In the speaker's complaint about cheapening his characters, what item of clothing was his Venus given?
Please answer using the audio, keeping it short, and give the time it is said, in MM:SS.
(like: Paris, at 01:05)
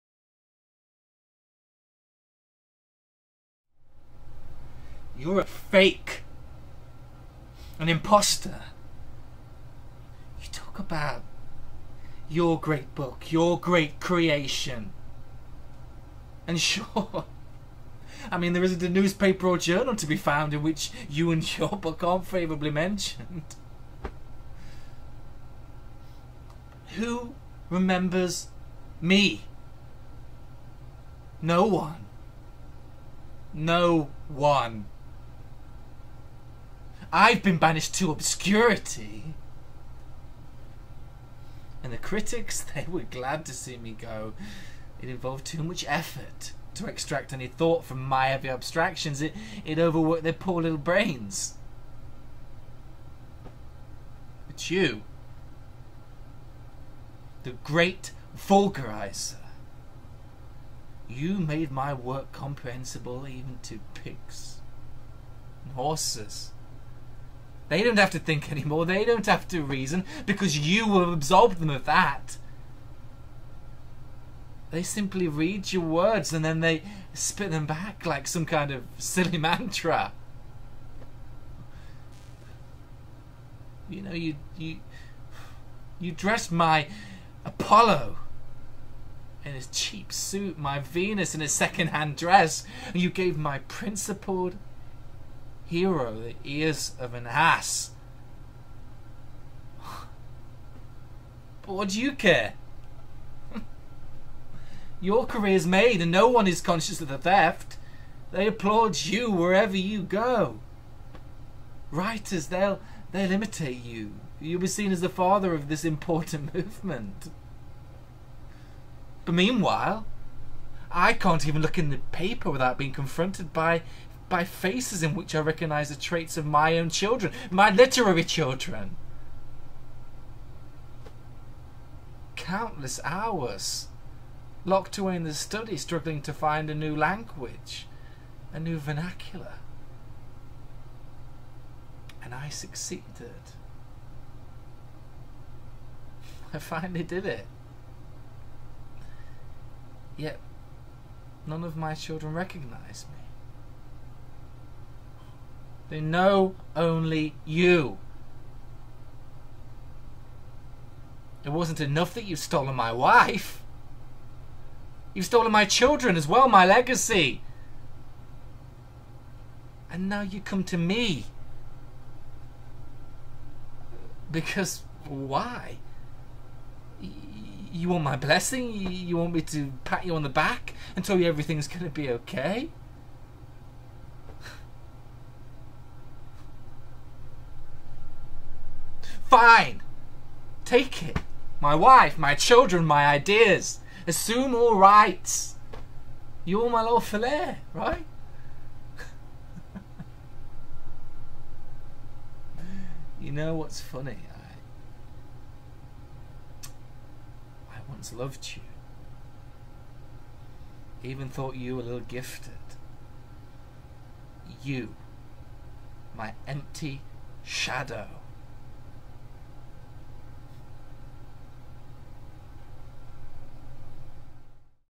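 second-hand dress, at 01:31.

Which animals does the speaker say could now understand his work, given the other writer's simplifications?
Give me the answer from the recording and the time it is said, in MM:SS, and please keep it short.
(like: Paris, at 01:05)
pigs and horses, at 01:03.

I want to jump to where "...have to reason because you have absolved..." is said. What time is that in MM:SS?
01:09.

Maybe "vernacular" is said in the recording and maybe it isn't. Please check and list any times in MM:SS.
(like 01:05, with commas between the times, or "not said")
02:18.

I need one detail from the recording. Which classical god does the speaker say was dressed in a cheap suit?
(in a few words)
Apollo.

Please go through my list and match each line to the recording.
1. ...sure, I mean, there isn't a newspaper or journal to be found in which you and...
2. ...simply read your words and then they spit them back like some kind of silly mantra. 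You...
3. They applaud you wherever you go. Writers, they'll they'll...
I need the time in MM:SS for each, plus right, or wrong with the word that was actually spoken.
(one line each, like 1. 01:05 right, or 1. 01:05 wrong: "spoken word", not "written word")
1. 00:16 right
2. 01:14 right
3. 01:48 right.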